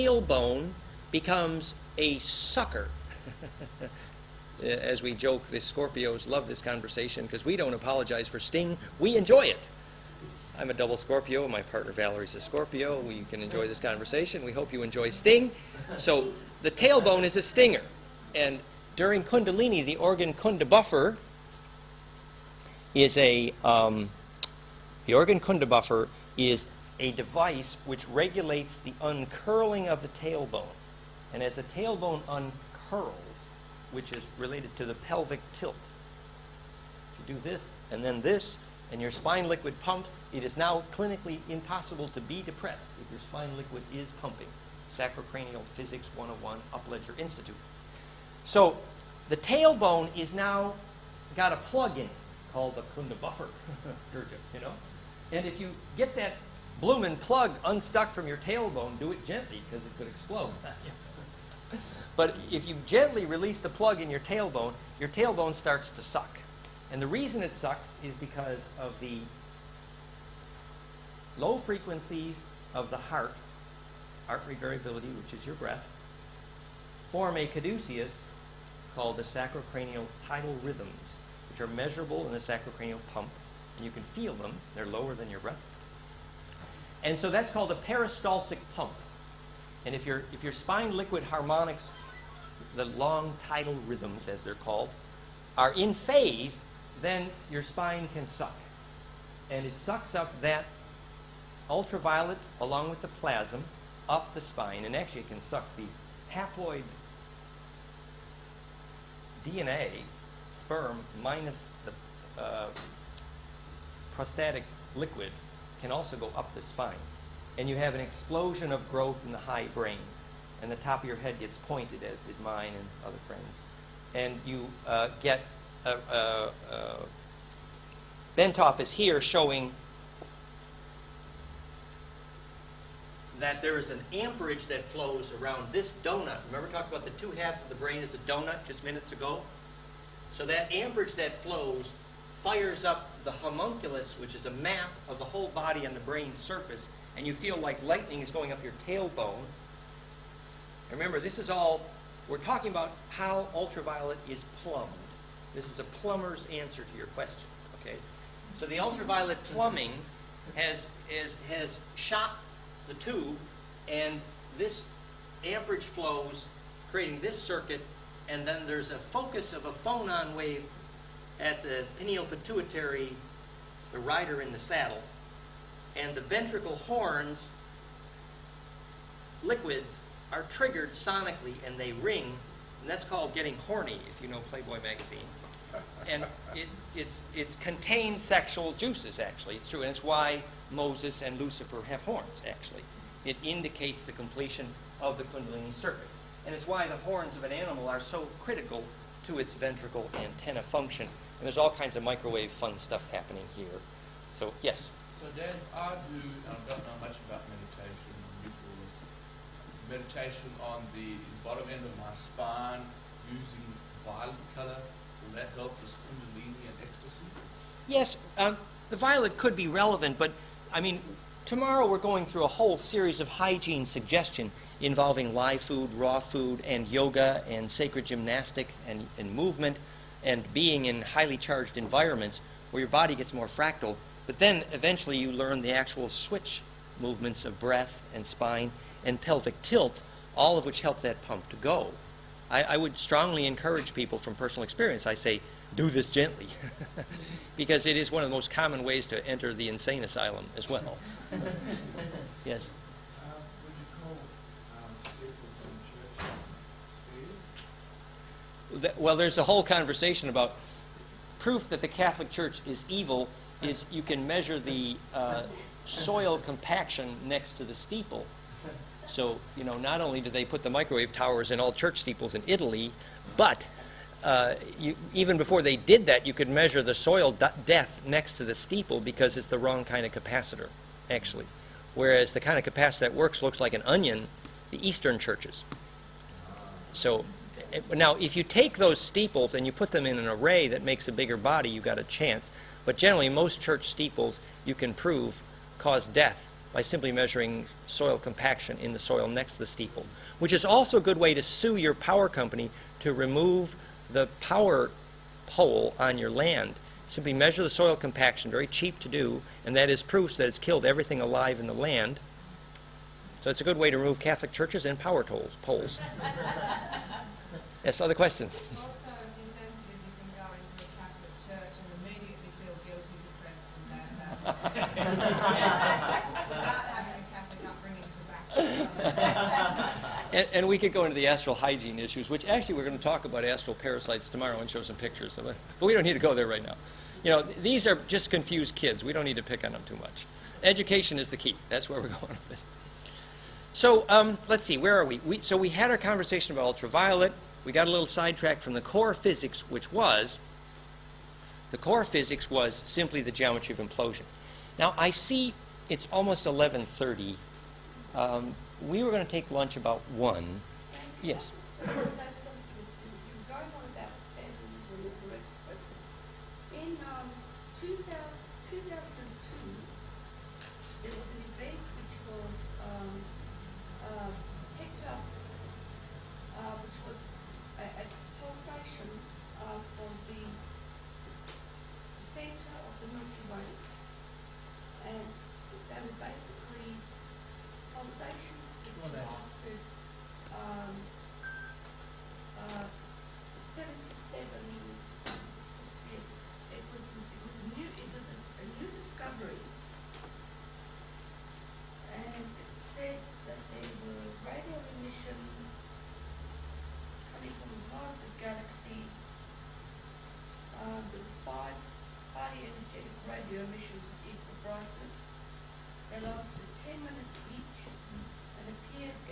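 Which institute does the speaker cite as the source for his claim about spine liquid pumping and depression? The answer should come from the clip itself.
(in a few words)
Upledger Institute.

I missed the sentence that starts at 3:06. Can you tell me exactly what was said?
And it, it's, it's contained sexual juices, actually.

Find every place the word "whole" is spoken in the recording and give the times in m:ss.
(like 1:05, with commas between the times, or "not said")
2:25, 3:42, 4:19.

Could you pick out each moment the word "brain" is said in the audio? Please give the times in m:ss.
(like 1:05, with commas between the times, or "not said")
1:59, 2:17, 2:26.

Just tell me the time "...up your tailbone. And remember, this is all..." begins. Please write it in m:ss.
2:28.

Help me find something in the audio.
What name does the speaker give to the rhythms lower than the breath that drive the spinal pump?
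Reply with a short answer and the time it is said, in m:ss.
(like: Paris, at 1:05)
sacrocranial tidal rhythms, at 1:19.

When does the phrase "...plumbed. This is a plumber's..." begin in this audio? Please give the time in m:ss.
2:34.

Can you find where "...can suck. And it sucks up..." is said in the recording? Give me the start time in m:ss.
1:38.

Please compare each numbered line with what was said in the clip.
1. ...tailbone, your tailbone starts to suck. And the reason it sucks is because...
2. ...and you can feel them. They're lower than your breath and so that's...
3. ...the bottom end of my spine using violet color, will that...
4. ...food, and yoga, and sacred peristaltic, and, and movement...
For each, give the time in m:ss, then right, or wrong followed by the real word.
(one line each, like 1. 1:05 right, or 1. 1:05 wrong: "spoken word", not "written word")
1. 1:04 right
2. 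1:23 right
3. 3:30 right
4. 3:46 wrong: "gymnastic", not "peristaltic".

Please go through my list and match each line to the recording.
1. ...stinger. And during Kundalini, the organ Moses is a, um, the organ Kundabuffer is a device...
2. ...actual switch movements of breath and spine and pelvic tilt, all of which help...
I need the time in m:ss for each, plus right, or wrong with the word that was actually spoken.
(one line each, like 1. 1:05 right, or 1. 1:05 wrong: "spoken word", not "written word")
1. 0:17 wrong: "Kundabuffer", not "Moses"
2. 3:55 right.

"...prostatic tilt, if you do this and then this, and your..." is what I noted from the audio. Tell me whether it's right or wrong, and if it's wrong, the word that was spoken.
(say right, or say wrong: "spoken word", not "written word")
wrong: "pelvic", not "prostatic".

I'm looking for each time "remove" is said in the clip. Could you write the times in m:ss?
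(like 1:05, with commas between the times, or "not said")
5:03, 5:13.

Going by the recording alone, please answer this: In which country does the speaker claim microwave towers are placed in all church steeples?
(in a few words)
Italy.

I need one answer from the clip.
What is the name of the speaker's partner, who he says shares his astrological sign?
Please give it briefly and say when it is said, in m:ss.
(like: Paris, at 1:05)
Valerie, at 0:11.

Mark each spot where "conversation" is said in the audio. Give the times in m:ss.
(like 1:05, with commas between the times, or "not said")
0:06, 0:13, 4:19, 5:45.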